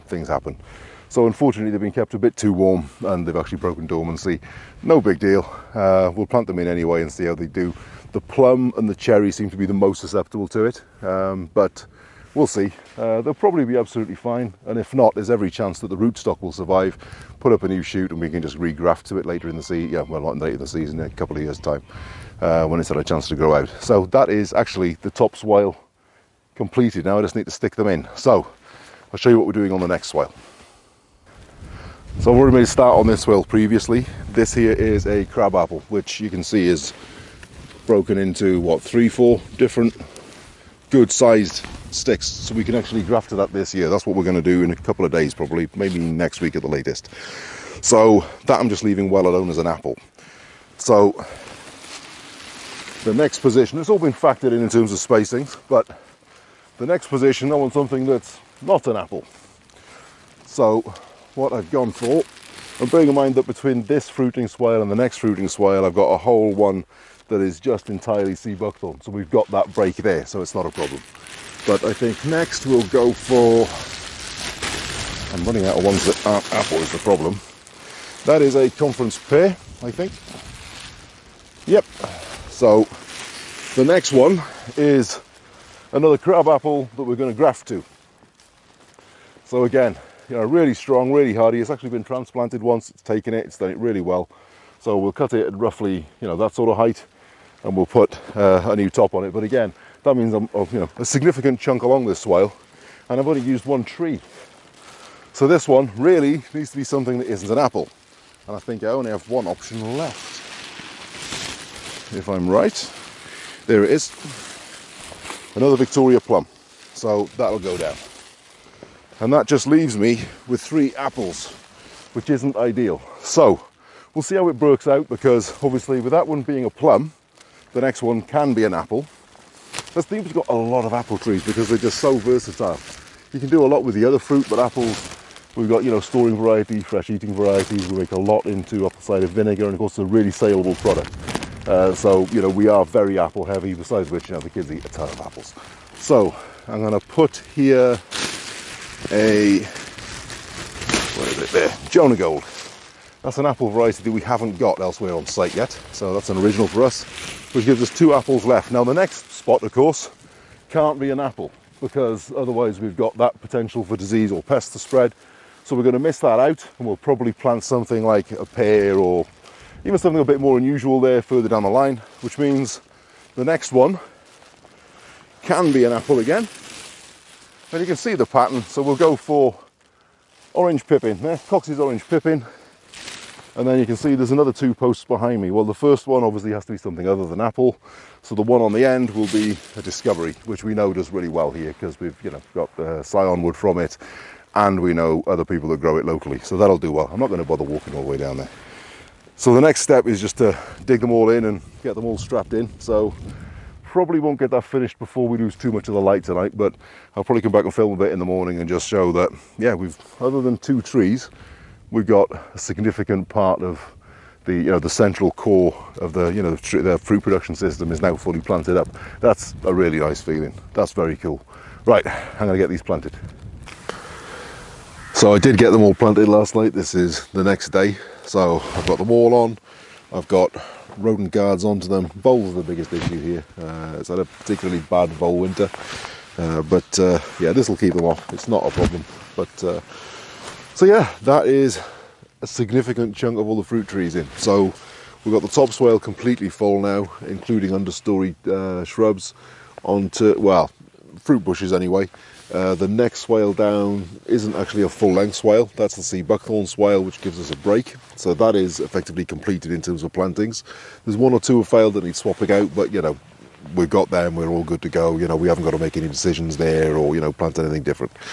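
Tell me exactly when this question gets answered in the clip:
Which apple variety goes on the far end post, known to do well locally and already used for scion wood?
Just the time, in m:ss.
3:09.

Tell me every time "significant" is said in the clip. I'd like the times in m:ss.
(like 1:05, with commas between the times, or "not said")
1:41, 3:32, 4:02.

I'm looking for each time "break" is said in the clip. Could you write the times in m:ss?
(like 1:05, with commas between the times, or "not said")
1:09, 4:17.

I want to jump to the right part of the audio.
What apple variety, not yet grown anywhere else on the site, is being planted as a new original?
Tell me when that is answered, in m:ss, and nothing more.
2:31.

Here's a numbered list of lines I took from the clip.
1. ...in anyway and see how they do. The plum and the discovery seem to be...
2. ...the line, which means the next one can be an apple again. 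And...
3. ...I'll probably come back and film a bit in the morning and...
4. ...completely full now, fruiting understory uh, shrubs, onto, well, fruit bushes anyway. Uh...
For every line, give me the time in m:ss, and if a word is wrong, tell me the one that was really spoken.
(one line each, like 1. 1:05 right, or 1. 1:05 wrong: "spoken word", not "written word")
1. 0:06 wrong: "cherry", not "discovery"
2. 2:51 right
3. 3:27 right
4. 4:05 wrong: "including", not "fruiting".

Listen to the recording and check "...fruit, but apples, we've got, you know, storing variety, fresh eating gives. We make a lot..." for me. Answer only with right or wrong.
wrong.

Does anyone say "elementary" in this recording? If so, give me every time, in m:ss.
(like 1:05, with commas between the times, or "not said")
not said.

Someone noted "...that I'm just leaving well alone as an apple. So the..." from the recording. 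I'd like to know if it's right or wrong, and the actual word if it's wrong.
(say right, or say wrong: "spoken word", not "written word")
right.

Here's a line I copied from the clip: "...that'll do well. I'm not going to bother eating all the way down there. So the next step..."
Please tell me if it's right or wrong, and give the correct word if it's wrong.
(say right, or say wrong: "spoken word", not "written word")
wrong: "walking", not "eating".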